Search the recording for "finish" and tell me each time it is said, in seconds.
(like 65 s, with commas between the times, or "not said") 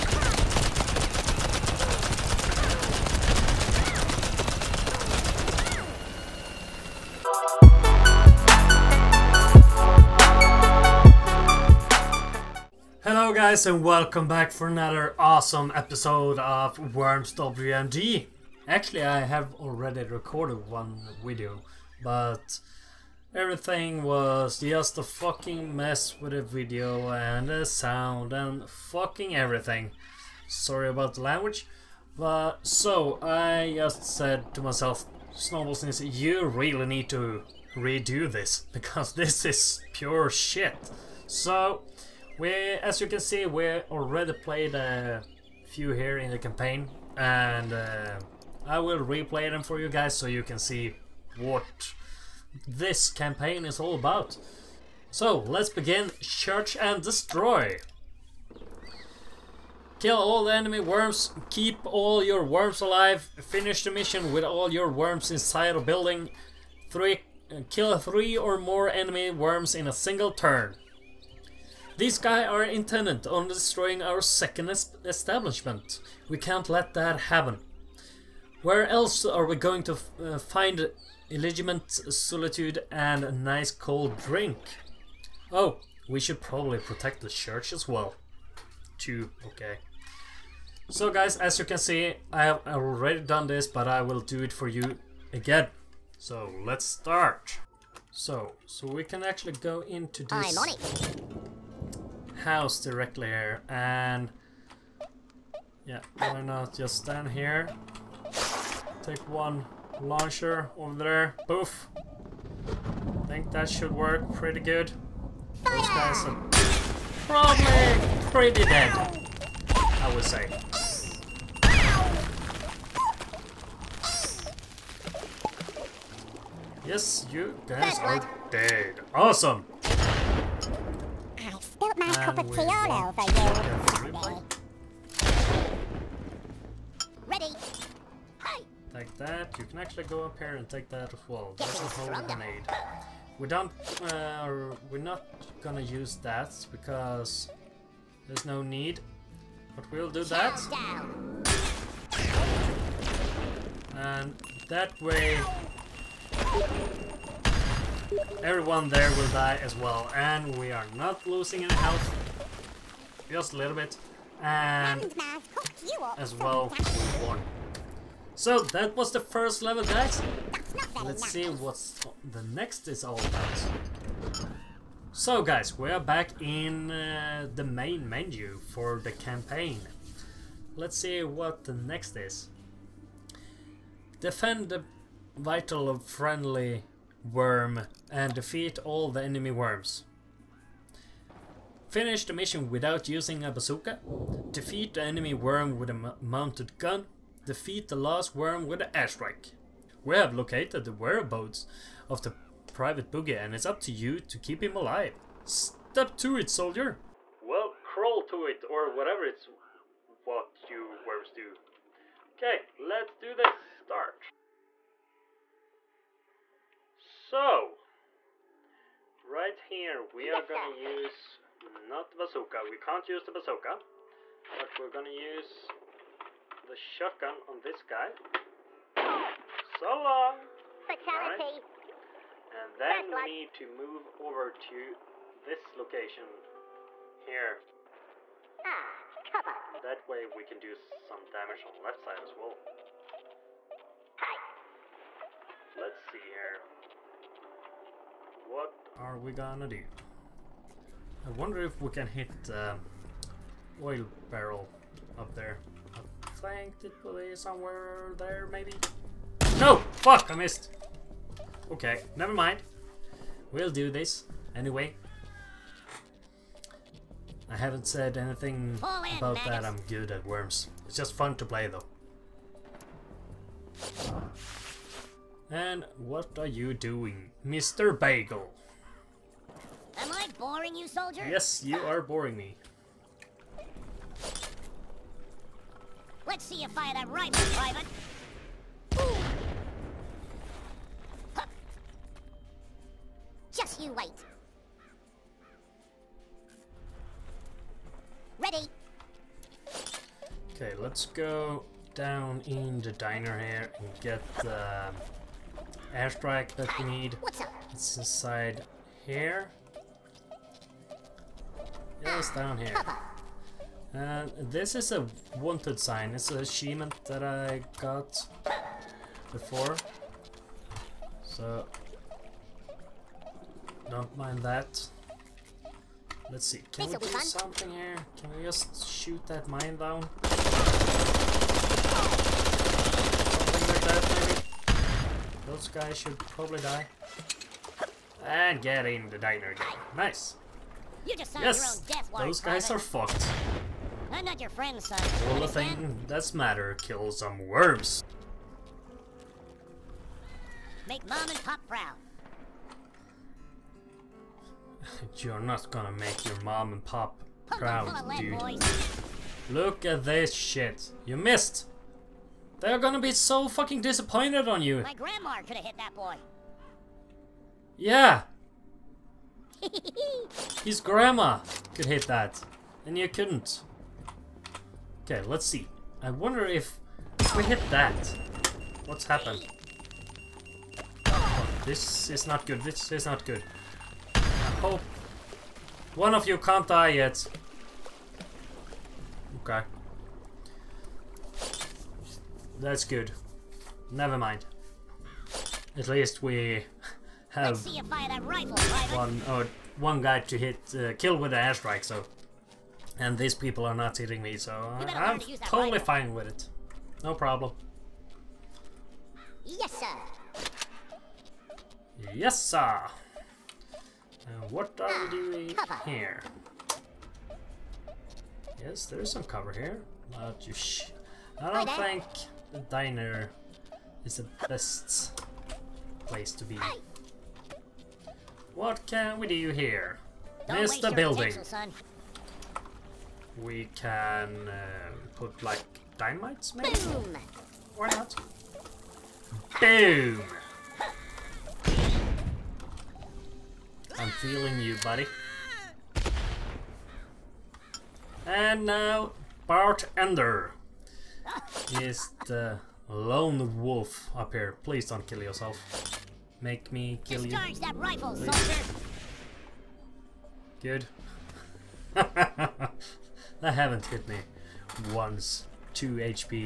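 63 s, 191 s.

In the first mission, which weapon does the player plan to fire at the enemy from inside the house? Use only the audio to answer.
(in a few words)
launcher.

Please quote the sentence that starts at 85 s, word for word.
Oh, we should probably protect the church as well.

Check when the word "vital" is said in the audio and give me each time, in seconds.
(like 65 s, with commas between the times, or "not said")
185 s.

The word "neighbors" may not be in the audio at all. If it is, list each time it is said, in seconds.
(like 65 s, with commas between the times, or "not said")
not said.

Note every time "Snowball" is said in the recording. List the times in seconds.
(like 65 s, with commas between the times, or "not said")
35 s.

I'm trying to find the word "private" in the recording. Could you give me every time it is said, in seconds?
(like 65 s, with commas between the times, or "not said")
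202 s, 287 s, 342 s.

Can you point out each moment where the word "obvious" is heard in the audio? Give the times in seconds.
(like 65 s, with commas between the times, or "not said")
not said.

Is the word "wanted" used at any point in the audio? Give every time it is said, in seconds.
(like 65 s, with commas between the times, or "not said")
315 s.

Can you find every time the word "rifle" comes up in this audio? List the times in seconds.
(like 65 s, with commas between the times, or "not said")
398 s, 405 s, 457 s.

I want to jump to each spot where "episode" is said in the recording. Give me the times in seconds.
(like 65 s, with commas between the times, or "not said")
15 s.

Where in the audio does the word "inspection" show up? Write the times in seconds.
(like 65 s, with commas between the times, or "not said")
not said.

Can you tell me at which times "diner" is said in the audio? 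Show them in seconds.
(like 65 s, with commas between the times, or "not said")
302 s, 339 s, 422 s.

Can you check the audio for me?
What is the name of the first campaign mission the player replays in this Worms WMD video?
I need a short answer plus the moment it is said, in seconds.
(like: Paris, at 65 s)
Church and Destroy, at 56 s.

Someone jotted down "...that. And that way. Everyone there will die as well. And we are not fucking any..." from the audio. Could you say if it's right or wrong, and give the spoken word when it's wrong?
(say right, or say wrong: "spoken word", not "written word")
wrong: "losing", not "fucking".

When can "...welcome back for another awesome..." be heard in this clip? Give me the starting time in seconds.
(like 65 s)
13 s.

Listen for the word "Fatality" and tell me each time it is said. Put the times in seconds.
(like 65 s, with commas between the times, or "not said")
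230 s.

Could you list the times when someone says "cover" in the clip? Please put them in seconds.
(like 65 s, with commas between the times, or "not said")
239 s, 419 s.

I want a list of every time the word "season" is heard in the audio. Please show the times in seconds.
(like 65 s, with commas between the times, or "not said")
not said.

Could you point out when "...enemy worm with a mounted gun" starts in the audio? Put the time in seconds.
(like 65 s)
195 s.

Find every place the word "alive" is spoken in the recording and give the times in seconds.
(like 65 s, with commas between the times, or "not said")
62 s, 204 s.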